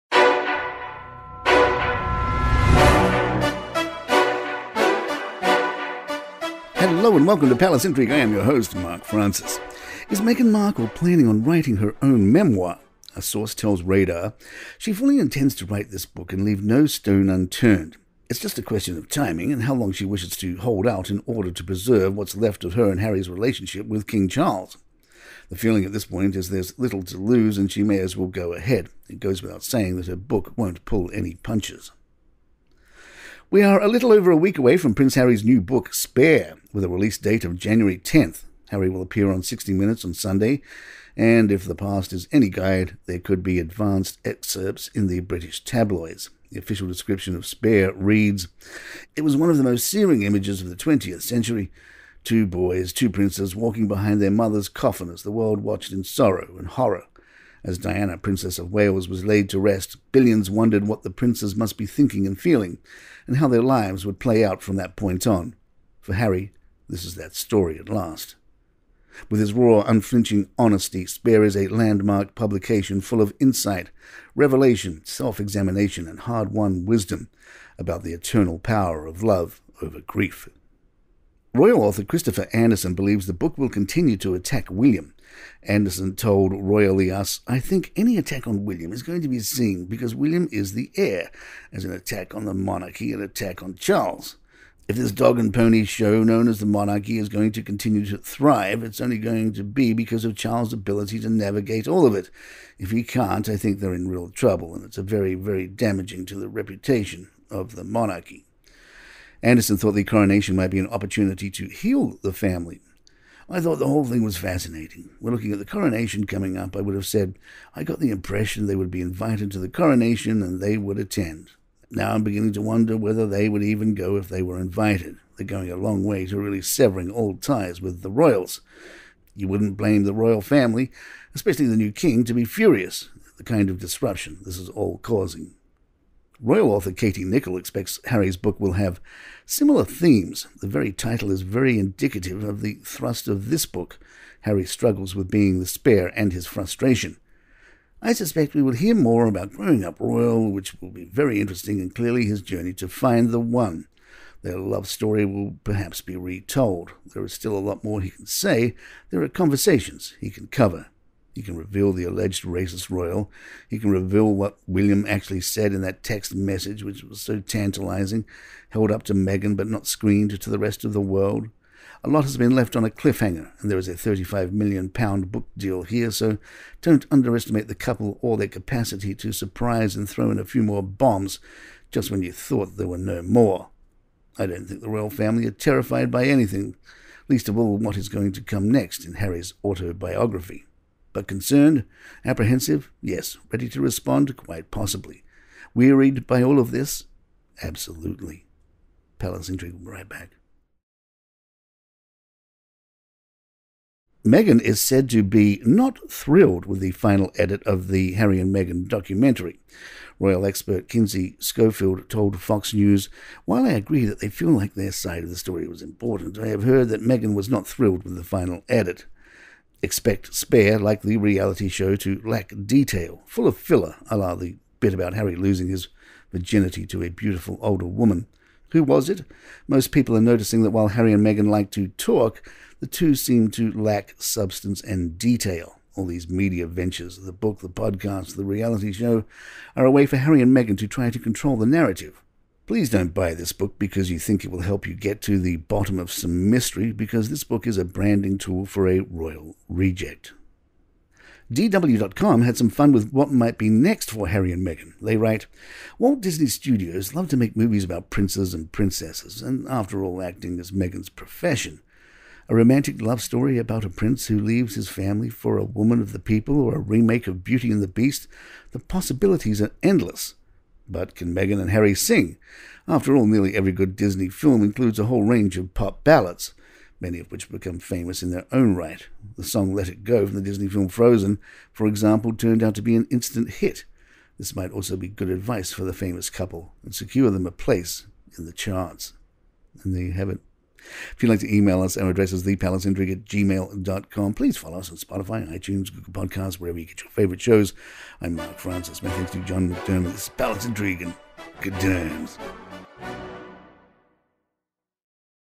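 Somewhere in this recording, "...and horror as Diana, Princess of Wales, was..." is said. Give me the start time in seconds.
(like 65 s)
56 s.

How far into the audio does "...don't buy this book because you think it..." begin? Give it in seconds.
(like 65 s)
242 s.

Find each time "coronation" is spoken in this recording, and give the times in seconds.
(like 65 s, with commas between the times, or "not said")
110 s, 115 s, 119 s.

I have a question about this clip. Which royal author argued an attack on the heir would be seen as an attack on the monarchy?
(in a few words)
Christopher Anderson.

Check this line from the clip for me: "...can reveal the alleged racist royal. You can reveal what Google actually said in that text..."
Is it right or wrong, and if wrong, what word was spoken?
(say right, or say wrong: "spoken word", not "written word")
wrong: "William", not "Google".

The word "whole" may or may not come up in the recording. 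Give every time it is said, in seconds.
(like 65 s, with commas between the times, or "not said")
113 s, 275 s.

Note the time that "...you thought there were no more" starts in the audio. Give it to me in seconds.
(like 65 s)
182 s.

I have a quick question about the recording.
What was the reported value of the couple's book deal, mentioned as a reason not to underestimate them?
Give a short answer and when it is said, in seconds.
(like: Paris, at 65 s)
£35 million, at 173 s.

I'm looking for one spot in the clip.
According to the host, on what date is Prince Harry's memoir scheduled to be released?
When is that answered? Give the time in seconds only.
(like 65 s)
37 s.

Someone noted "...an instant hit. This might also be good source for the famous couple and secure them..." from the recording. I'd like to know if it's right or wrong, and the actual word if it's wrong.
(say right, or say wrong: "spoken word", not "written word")
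wrong: "advice", not "source".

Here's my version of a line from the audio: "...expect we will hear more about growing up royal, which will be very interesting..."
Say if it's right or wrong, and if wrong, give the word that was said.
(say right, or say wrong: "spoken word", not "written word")
wrong: "suspect", not "expect".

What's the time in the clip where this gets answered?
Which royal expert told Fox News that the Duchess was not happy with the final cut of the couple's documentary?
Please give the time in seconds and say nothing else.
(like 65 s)
210 s.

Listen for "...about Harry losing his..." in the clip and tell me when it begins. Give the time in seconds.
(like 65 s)
224 s.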